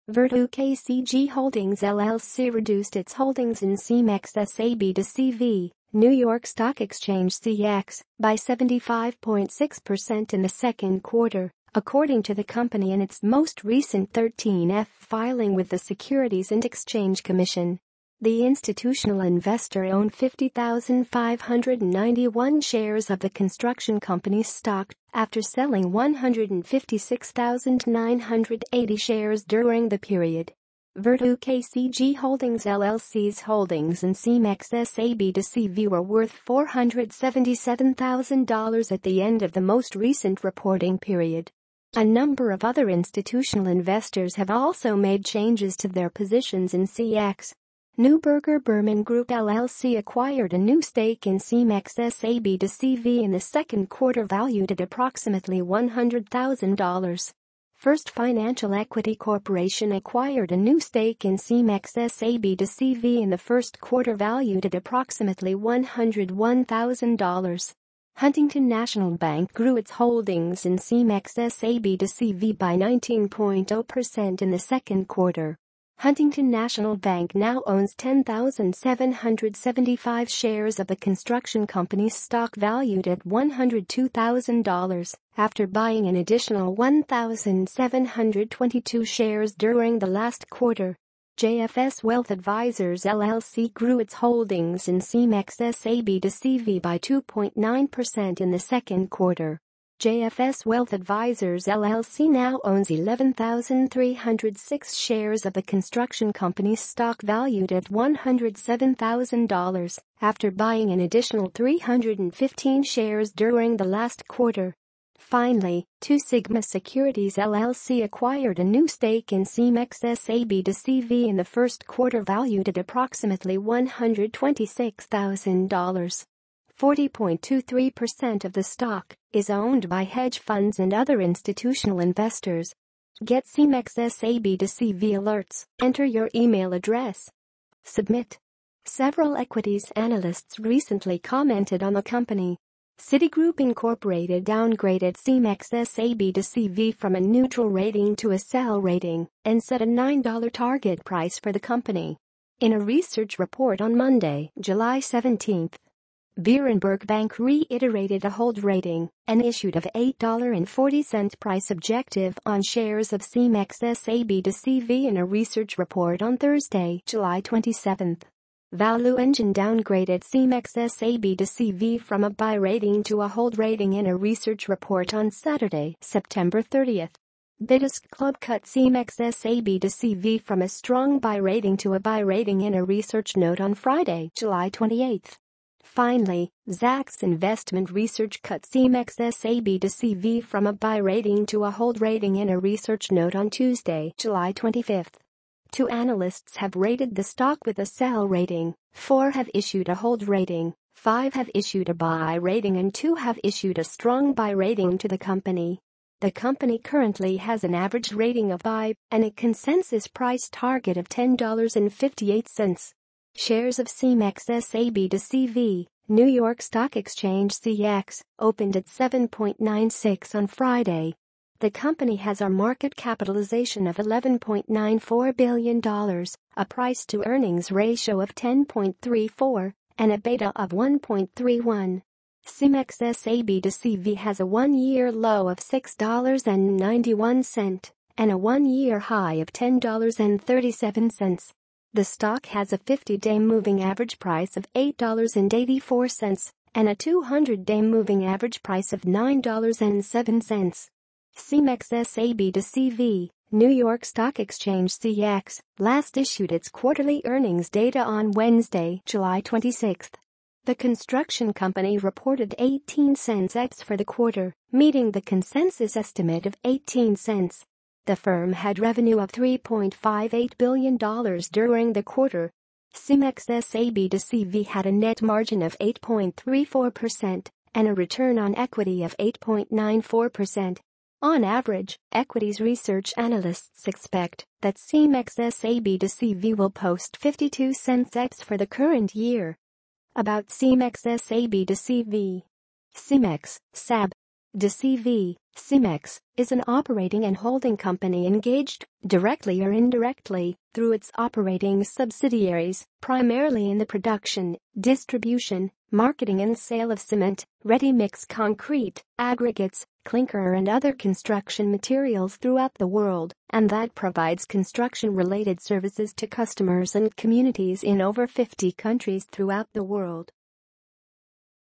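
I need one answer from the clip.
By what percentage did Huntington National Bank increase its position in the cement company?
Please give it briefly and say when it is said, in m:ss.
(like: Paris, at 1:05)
19.0%, at 1:12.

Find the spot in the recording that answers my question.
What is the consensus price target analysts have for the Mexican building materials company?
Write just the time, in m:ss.
3:31.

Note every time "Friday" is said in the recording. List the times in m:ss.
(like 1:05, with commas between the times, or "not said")
3:03, 3:40.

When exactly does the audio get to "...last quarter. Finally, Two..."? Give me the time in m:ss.
1:53.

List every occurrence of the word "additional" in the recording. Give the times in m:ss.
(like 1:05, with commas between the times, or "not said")
1:26, 1:51.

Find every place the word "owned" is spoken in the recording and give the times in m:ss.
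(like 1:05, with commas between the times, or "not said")
0:19, 2:09.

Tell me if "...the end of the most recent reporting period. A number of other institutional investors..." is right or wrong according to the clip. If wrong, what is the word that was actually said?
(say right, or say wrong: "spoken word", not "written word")
right.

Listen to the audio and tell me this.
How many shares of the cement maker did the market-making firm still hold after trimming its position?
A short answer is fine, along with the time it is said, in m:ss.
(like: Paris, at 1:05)
50,591, at 0:20.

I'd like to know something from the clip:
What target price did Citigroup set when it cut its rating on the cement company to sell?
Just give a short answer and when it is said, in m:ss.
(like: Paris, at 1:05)
$9, at 2:29.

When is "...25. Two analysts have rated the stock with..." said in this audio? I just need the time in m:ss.
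3:14.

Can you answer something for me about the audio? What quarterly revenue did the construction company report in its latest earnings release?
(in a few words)
$3.58 billion.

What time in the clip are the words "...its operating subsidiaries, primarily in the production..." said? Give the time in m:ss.
5:00.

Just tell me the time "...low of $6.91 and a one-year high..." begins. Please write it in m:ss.
3:55.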